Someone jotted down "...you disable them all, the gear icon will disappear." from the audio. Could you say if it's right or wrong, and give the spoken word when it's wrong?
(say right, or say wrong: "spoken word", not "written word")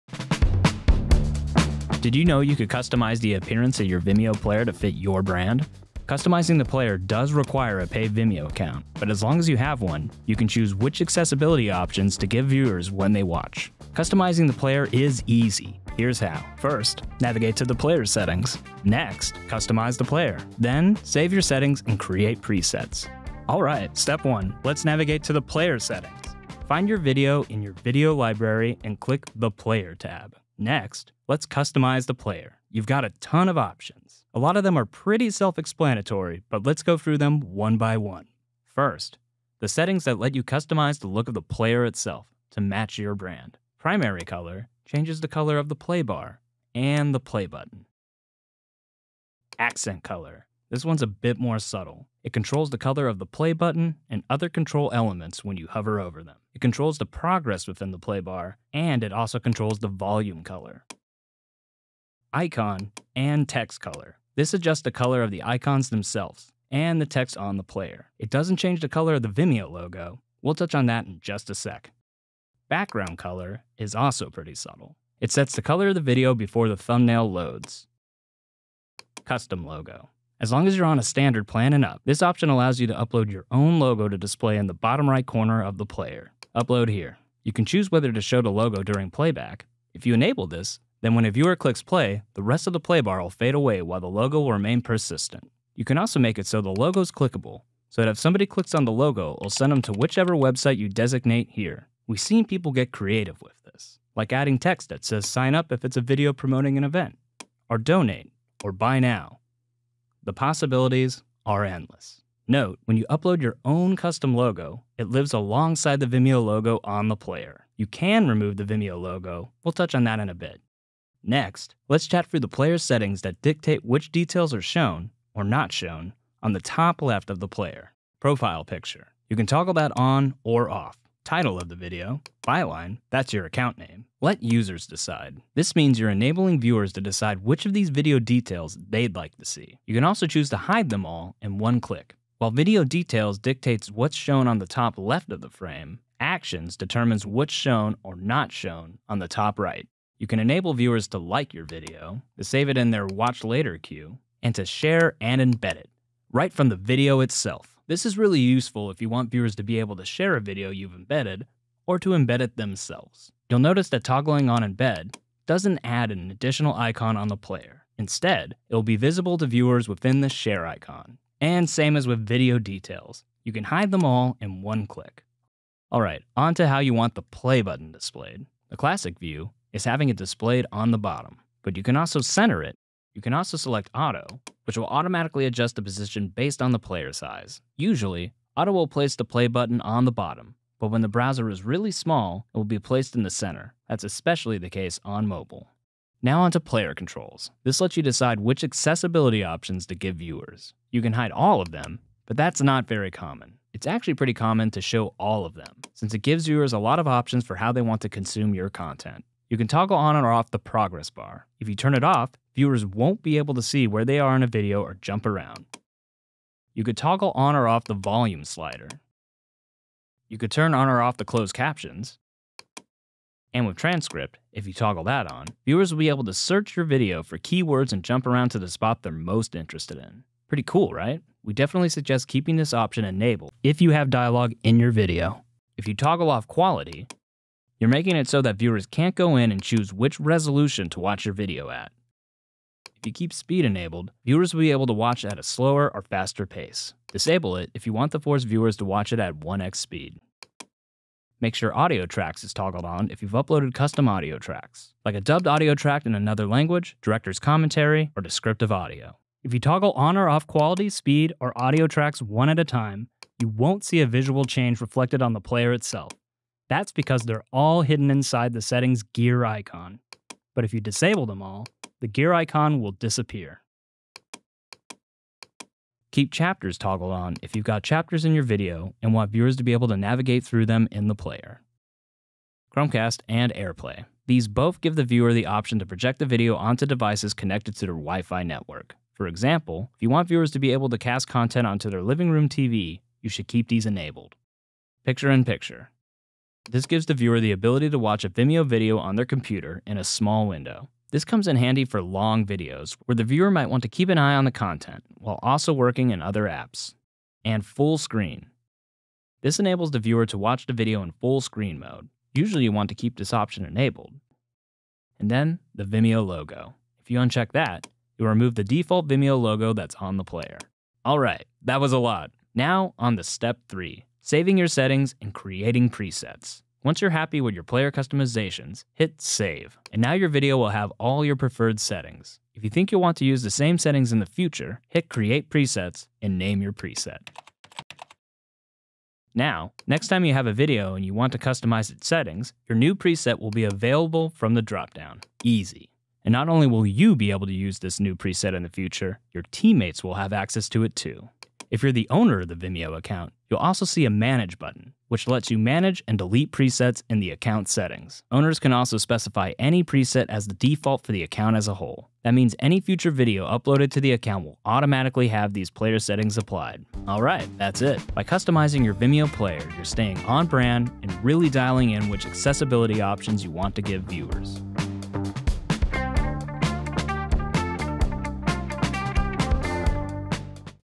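right.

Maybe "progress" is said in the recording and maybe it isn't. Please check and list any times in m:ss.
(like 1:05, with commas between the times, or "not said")
0:57, 3:30.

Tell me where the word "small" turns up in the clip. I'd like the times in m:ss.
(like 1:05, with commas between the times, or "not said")
3:11, 5:00.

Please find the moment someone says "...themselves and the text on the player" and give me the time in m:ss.
1:05.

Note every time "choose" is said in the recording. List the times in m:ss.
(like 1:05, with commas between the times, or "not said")
0:10, 1:27, 2:20, 3:59.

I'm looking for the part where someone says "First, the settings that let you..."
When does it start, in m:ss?
0:38.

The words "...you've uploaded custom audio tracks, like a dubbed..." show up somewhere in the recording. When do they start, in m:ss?
4:13.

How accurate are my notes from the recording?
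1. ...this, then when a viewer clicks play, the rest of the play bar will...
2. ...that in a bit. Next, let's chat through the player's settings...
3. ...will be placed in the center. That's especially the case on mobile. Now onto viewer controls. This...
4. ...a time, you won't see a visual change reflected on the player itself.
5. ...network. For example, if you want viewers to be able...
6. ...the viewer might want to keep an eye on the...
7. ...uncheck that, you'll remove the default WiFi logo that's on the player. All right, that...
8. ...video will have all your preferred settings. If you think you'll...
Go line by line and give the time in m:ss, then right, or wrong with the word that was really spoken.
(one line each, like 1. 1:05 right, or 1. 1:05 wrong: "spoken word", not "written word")
1. 1:30 right
2. 2:00 right
3. 3:12 wrong: "player", not "viewer"
4. 4:22 right
5. 4:48 right
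6. 5:03 right
7. 5:17 wrong: "Vimeo", not "WiFi"
8. 5:30 right.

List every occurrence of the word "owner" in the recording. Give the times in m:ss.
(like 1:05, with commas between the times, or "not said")
5:52, 5:58.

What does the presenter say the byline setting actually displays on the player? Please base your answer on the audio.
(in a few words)
Your account name.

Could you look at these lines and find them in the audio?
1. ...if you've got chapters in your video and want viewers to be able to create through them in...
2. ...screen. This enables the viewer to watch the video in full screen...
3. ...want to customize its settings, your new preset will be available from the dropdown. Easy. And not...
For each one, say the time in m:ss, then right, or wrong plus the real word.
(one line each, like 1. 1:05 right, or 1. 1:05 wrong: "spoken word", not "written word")
1. 4:37 wrong: "navigate", not "create"
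2. 5:07 right
3. 5:41 right.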